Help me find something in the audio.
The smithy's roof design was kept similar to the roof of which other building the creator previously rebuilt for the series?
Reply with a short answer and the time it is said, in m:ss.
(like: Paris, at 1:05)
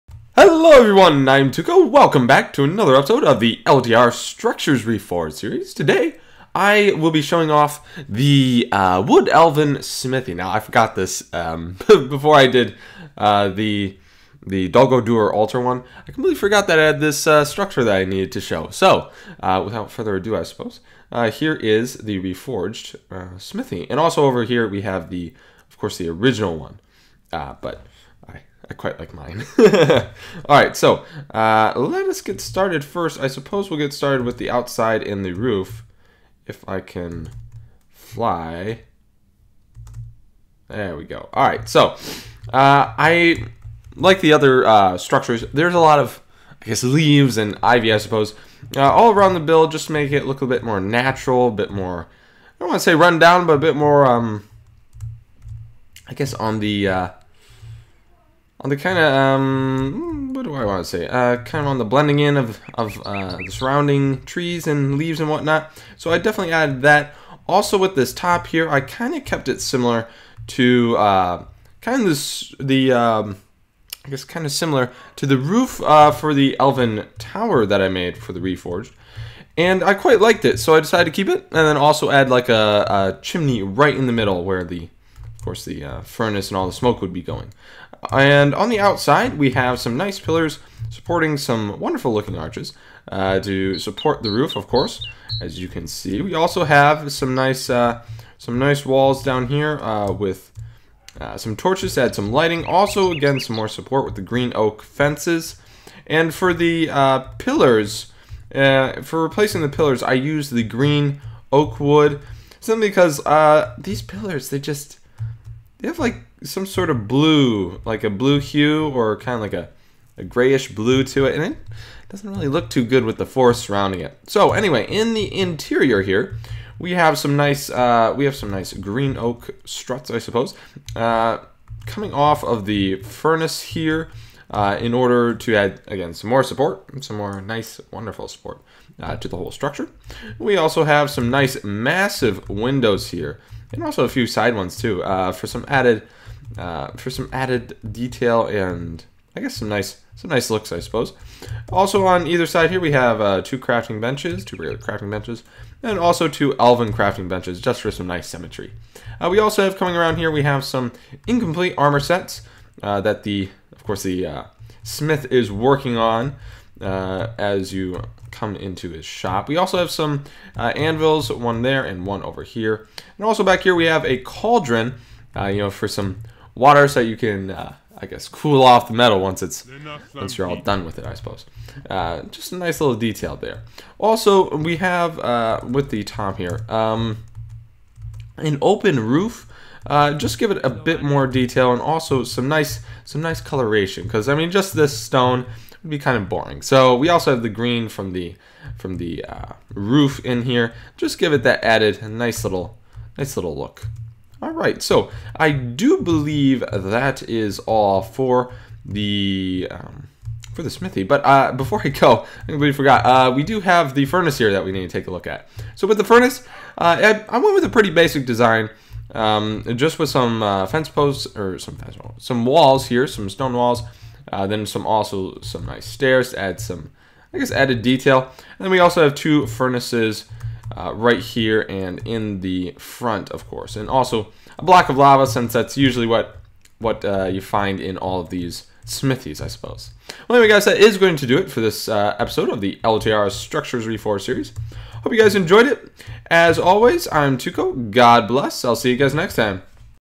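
Elven Tower, at 1:16.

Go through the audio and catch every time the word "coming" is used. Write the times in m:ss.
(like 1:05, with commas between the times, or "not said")
2:11, 2:39.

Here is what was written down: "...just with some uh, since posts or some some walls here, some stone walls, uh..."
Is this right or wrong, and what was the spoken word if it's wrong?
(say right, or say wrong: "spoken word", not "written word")
wrong: "fence", not "since".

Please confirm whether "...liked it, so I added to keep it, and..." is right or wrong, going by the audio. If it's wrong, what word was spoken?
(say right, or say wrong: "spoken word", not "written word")
wrong: "decided", not "added".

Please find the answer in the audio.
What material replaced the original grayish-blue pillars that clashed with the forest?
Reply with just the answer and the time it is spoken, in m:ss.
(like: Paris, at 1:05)
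green oak wood, at 1:50.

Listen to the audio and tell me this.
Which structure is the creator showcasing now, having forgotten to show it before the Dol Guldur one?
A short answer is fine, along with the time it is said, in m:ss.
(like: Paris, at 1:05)
Wood Elven Smithy, at 0:09.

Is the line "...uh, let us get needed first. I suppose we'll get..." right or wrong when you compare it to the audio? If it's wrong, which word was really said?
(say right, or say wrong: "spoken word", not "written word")
wrong: "started", not "needed".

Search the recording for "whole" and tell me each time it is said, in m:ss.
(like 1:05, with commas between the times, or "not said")
2:19.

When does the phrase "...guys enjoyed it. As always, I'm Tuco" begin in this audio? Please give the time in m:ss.
4:05.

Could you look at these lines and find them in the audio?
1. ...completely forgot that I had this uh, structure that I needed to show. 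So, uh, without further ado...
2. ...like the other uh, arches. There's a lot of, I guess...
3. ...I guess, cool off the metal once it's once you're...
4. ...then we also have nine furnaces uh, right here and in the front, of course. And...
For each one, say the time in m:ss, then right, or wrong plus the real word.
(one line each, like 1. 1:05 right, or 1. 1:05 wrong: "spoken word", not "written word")
1. 0:16 right
2. 0:43 wrong: "structures", not "arches"
3. 2:57 right
4. 3:48 wrong: "two", not "nine".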